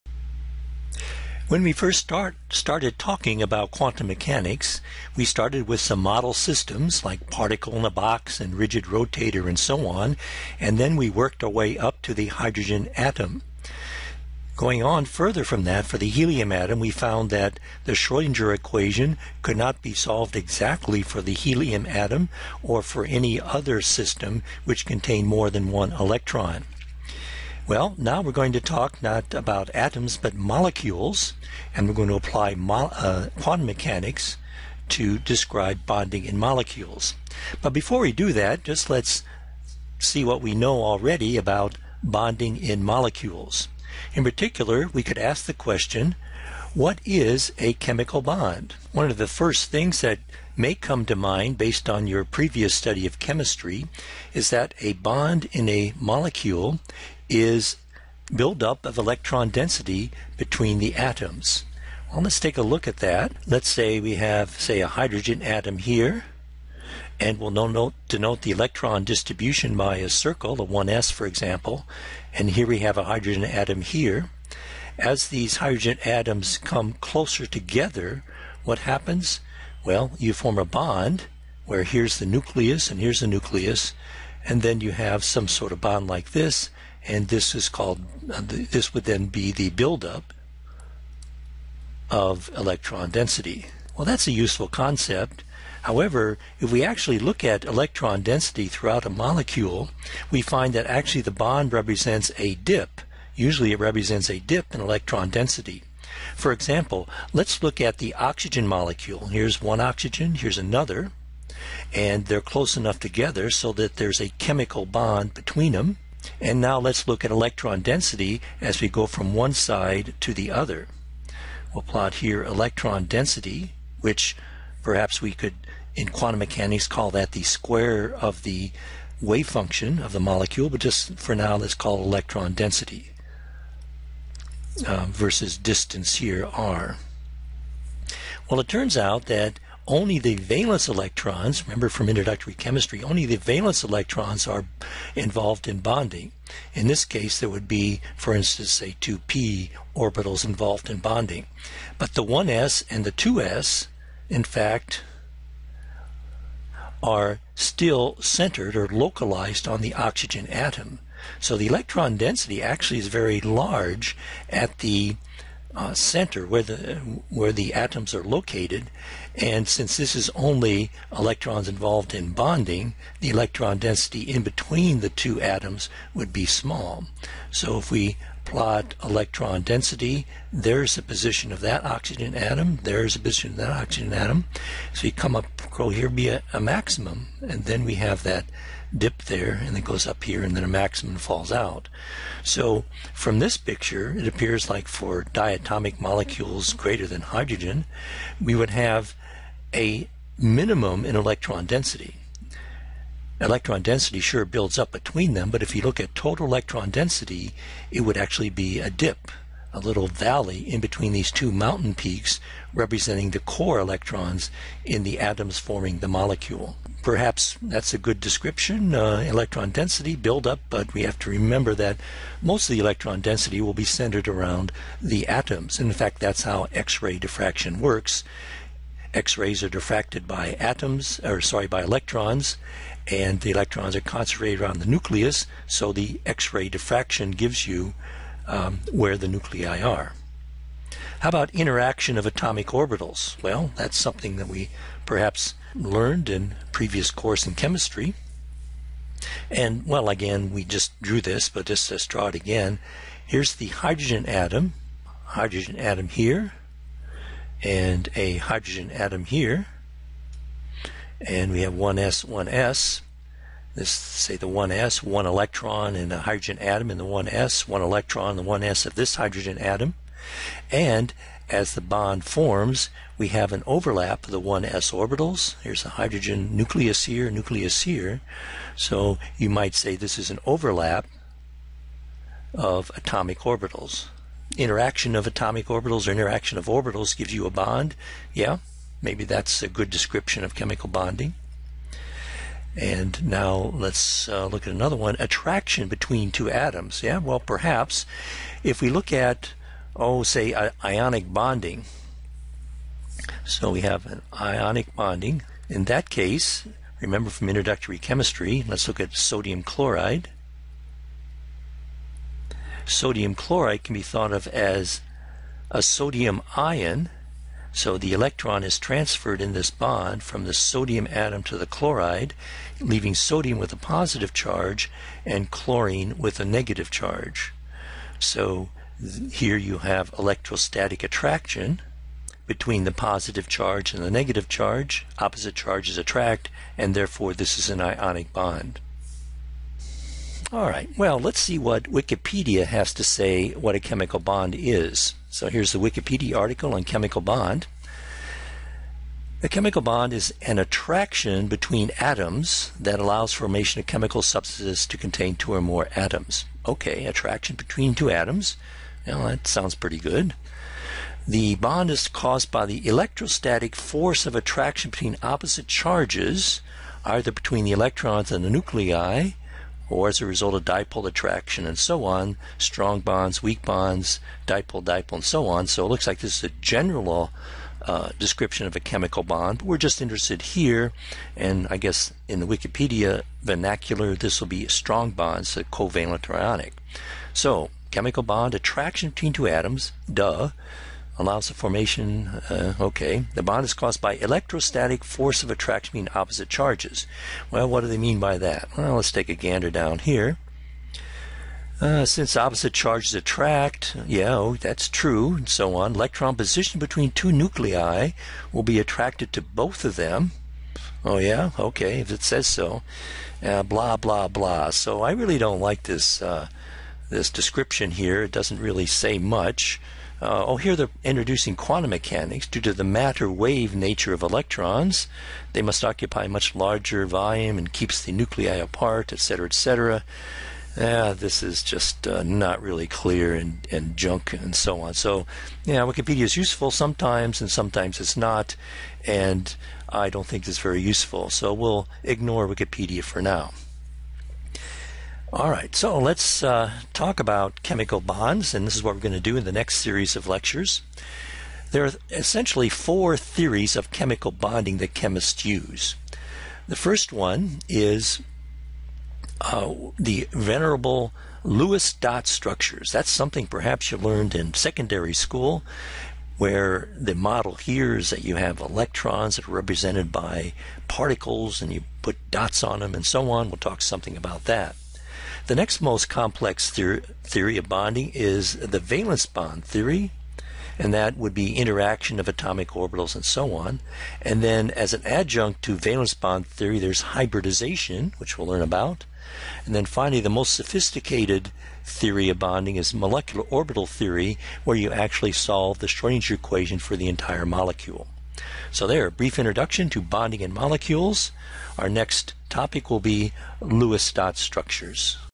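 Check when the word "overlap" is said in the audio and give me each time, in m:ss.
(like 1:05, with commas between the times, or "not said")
4:33, 4:40.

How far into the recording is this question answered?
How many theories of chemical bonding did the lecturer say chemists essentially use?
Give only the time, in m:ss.
7:32.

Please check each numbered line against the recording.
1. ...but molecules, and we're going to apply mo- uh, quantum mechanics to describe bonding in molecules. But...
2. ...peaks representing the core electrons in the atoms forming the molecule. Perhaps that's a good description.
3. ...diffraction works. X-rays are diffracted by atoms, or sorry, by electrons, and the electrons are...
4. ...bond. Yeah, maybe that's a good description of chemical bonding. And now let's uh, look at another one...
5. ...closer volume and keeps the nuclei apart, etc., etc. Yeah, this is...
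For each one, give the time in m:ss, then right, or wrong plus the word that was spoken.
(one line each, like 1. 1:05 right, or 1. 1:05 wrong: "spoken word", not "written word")
1. 0:30 right
2. 3:31 right
3. 3:47 right
4. 4:47 right
5. 7:06 wrong: "larger", not "closer".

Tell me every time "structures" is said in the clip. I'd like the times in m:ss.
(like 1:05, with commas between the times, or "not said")
7:42, 8:24.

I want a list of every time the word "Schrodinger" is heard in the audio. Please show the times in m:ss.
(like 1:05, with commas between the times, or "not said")
0:17, 8:15.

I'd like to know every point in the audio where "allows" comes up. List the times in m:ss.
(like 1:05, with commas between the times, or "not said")
5:52, 6:31.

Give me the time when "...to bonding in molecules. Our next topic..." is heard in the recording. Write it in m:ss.
8:19.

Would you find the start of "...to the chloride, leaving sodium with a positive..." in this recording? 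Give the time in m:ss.
5:21.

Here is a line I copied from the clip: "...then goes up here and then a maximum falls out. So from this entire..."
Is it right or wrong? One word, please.
wrong.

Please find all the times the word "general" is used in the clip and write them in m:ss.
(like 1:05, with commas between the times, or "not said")
6:16.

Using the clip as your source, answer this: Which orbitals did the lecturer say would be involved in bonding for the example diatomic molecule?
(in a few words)
2p orbitals.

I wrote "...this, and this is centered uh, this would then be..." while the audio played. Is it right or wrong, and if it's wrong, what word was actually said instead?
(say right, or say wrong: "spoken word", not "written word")
wrong: "called", not "centered".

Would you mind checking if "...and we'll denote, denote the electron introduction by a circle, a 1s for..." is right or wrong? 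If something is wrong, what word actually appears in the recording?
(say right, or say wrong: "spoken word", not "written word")
wrong: "distribution", not "introduction".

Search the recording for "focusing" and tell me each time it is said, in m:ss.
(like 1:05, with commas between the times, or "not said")
not said.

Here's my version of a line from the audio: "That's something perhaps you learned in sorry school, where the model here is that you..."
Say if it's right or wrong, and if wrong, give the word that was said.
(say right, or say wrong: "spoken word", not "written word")
wrong: "secondary", not "sorry".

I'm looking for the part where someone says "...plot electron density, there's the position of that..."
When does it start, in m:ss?
2:58.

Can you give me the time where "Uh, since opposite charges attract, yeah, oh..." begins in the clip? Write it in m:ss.
6:41.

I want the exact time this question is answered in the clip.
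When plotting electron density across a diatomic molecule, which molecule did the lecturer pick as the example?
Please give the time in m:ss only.
1:48.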